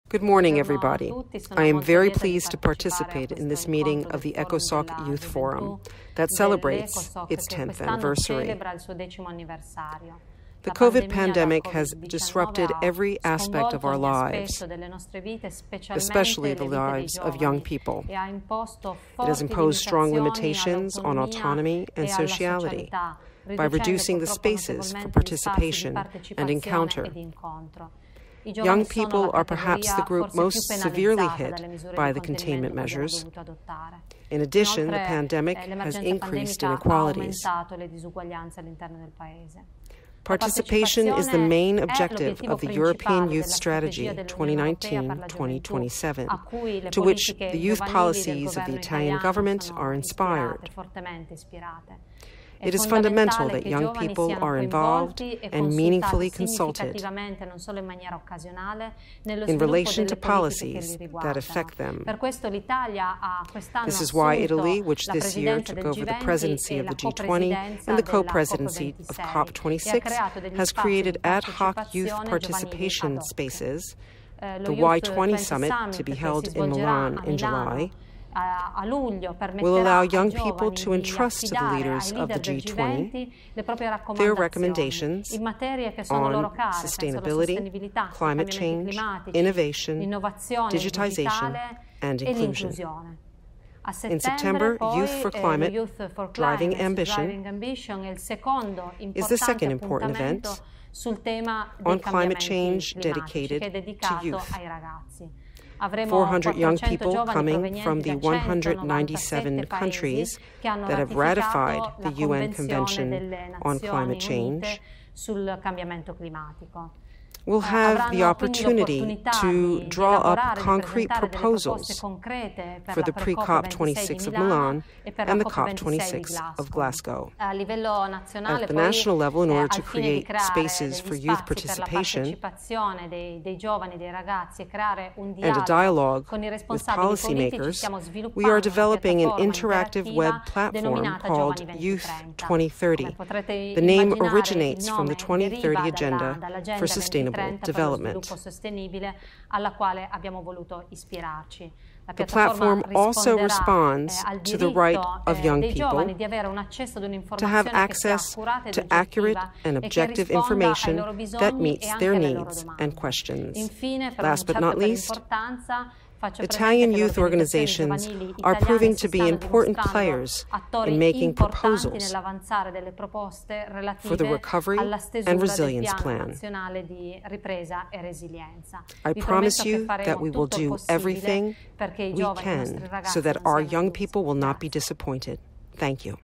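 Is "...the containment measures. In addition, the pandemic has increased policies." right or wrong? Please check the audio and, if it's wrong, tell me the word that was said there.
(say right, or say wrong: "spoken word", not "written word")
wrong: "inequalities", not "policies".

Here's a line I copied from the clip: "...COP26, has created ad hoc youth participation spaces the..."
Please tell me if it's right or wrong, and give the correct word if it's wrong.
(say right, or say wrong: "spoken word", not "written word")
right.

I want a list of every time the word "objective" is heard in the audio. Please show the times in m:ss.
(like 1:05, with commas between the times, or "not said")
0:41, 2:39.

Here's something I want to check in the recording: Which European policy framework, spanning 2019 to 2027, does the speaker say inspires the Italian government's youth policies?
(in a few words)
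European Youth Strategy.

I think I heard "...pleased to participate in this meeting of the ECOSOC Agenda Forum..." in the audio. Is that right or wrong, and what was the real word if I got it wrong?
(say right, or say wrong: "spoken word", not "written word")
wrong: "Youth", not "Agenda".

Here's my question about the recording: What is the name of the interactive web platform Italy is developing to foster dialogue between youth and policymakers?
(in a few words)
Youth 2030.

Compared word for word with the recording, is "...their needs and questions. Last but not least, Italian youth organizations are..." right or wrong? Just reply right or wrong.
right.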